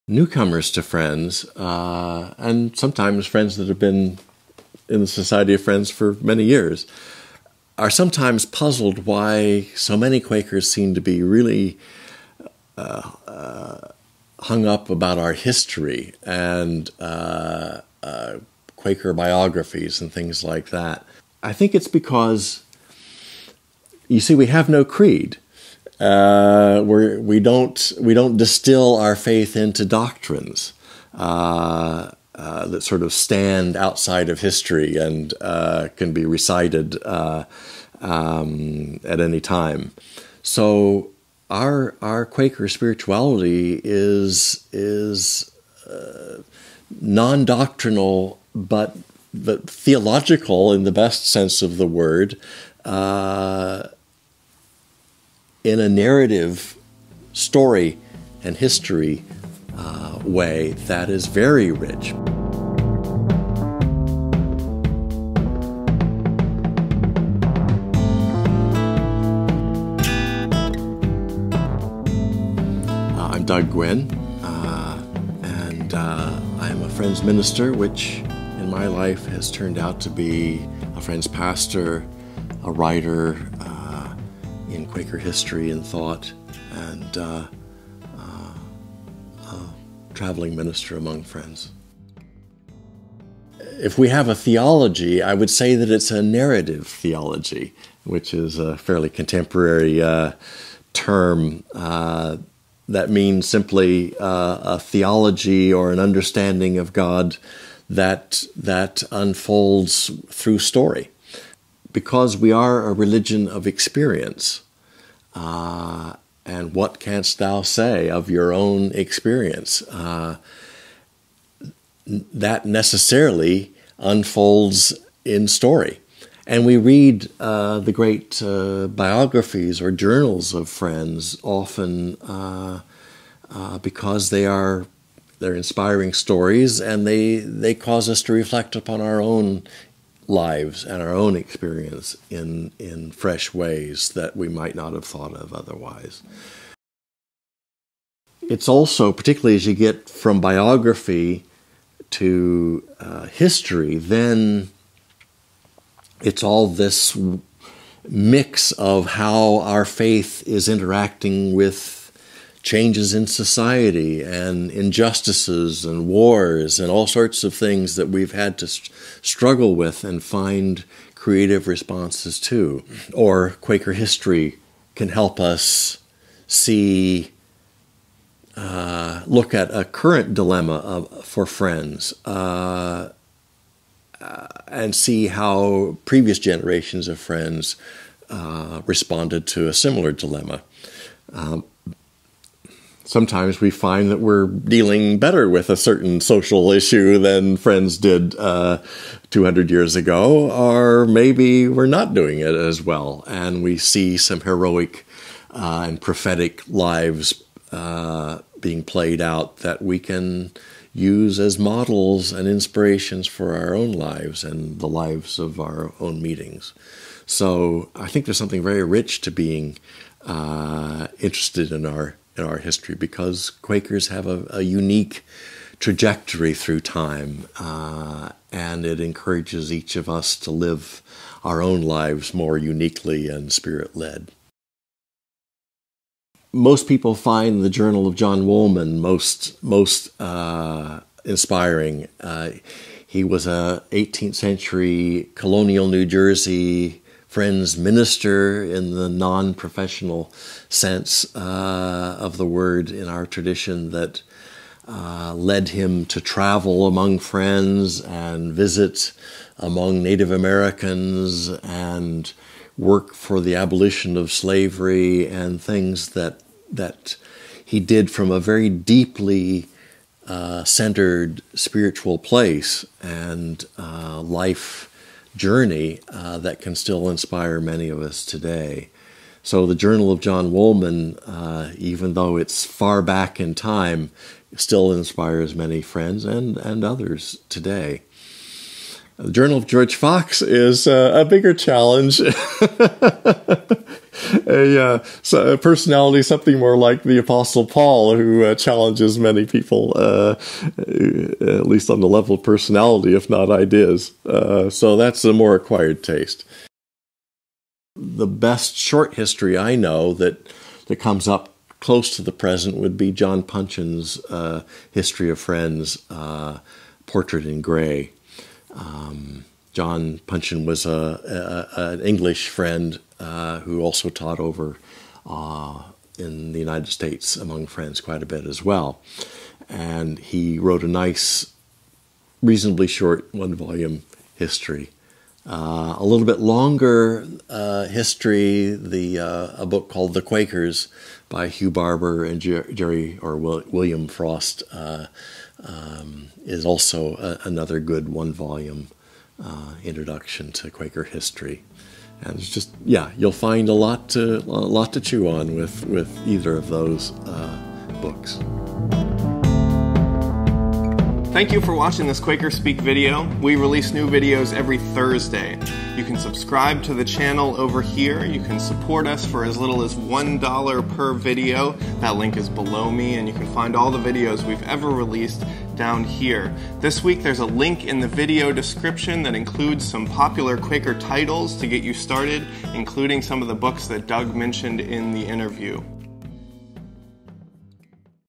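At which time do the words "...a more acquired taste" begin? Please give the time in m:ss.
5:05.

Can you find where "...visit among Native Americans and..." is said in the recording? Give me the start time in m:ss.
4:18.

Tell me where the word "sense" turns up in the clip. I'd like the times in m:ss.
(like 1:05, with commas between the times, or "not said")
0:51, 4:10.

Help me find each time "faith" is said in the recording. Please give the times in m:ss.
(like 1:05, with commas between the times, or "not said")
0:29, 2:39.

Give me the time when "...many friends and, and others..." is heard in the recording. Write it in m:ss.
4:45.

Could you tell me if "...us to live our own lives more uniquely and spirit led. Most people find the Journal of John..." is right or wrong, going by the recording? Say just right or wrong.
right.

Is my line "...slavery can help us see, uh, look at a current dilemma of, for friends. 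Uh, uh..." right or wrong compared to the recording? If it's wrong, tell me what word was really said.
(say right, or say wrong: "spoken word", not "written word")
wrong: "history", not "slavery".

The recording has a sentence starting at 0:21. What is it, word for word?
I think it's because, you see, we have no creed.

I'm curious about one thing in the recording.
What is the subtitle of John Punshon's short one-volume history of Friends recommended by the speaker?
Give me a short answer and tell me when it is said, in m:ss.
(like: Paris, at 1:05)
Portrait in Gray, at 5:17.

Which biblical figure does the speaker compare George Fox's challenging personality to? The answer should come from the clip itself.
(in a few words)
the Apostle Paul.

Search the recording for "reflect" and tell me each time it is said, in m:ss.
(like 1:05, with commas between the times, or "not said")
2:18.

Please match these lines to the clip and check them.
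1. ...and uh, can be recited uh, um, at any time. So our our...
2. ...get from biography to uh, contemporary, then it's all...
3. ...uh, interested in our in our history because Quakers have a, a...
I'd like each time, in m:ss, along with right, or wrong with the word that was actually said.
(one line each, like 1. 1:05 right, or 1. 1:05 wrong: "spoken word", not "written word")
1. 0:34 right
2. 2:29 wrong: "history", not "contemporary"
3. 3:40 right.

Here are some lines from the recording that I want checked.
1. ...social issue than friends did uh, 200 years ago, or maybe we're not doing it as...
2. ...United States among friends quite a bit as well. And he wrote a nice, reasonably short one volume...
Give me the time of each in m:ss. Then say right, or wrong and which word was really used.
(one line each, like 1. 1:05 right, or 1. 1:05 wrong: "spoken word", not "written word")
1. 3:16 right
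2. 5:26 right.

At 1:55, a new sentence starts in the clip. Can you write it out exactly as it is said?
Uh, and what canst thou say of your own experience?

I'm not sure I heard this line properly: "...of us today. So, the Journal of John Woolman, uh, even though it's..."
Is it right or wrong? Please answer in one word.
right.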